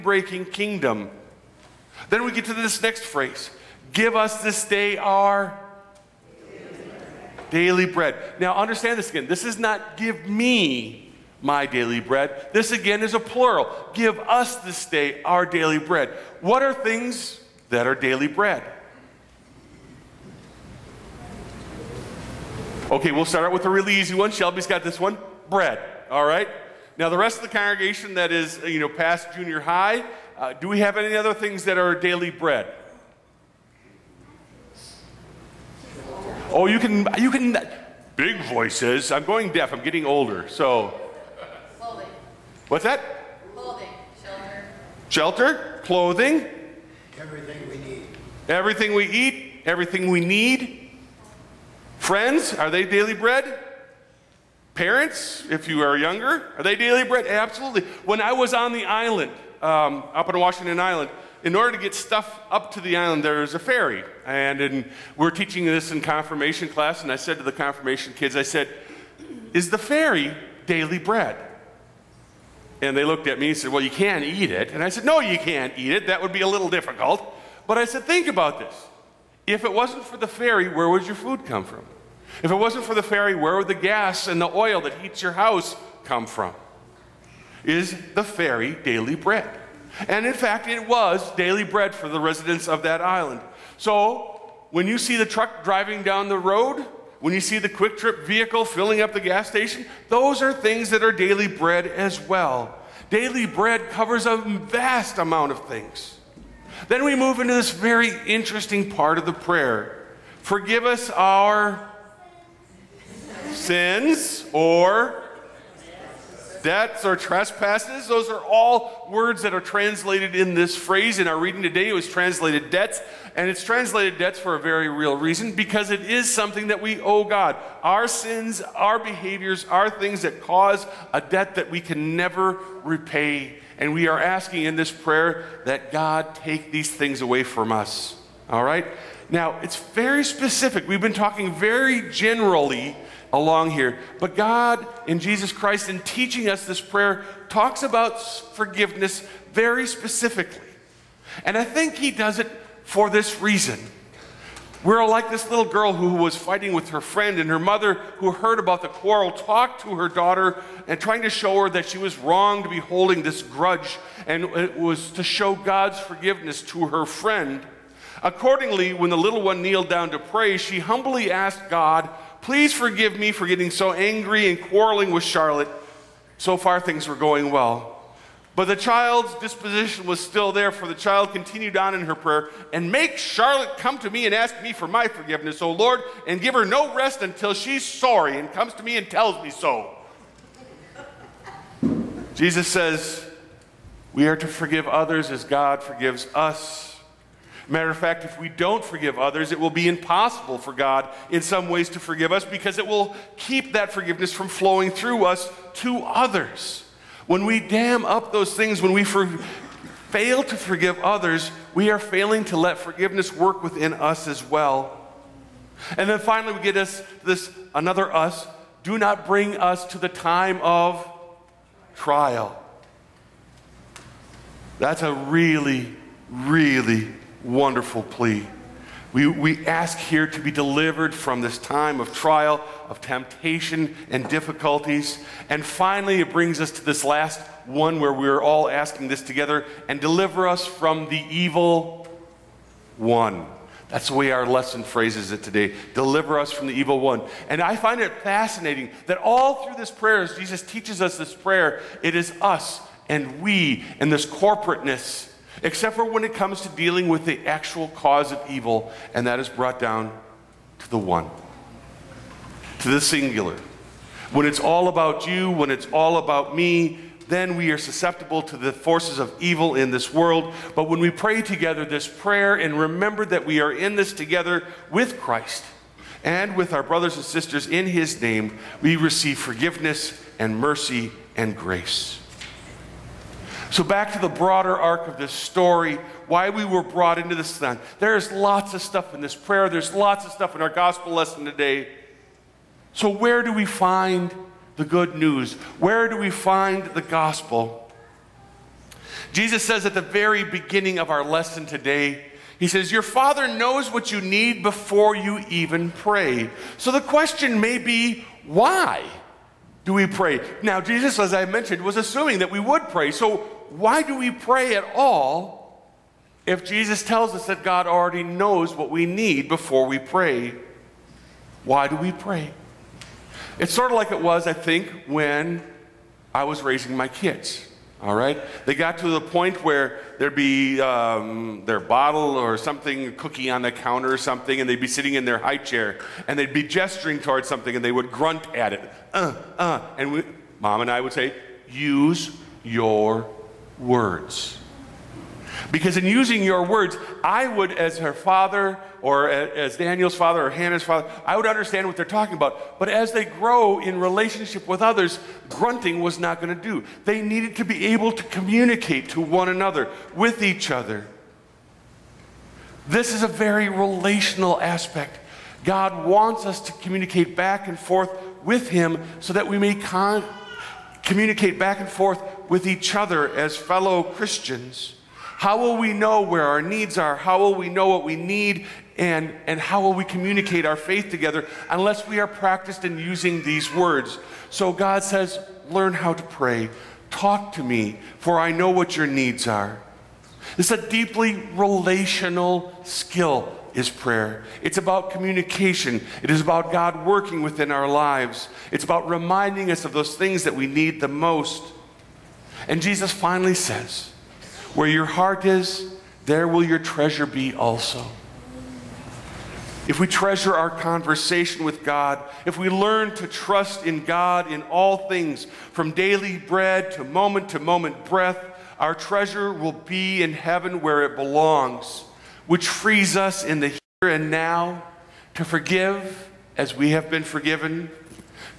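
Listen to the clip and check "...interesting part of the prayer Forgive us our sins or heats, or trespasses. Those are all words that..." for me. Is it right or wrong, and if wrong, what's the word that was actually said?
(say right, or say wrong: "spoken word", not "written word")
wrong: "debts", not "heats".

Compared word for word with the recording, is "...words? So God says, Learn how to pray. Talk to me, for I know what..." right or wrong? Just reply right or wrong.
right.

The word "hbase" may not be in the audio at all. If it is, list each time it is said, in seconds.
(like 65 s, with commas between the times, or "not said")
not said.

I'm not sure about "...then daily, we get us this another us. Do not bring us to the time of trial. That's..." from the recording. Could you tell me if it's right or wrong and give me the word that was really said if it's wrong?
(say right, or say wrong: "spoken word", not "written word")
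wrong: "finally", not "daily".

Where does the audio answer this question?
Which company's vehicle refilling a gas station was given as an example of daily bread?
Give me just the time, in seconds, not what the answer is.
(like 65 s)
97 s.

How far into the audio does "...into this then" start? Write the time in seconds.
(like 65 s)
287 s.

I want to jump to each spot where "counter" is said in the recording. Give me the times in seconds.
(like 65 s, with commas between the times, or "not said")
333 s.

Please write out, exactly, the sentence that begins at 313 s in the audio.
So why do we pray at all if Jesus tells us that God already knows what we need before we pray?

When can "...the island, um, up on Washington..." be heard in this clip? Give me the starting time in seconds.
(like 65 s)
58 s.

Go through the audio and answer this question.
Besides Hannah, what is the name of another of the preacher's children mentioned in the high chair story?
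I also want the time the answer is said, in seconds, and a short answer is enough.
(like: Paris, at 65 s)
Daniel, at 349 s.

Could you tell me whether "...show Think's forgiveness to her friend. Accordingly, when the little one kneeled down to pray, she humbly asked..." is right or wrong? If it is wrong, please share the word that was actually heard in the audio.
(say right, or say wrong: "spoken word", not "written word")
wrong: "God", not "Think".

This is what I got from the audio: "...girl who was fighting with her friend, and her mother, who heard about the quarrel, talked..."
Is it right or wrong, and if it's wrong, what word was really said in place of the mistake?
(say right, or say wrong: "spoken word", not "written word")
right.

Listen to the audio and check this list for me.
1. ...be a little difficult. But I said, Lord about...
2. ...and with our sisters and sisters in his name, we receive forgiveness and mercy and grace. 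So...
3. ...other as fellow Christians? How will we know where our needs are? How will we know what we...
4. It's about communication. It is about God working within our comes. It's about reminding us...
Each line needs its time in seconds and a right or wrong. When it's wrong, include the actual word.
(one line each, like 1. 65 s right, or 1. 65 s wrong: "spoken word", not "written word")
1. 76 s wrong: "Think", not "Lord"
2. 276 s wrong: "brothers", not "sisters"
3. 372 s right
4. 394 s wrong: "lives", not "comes".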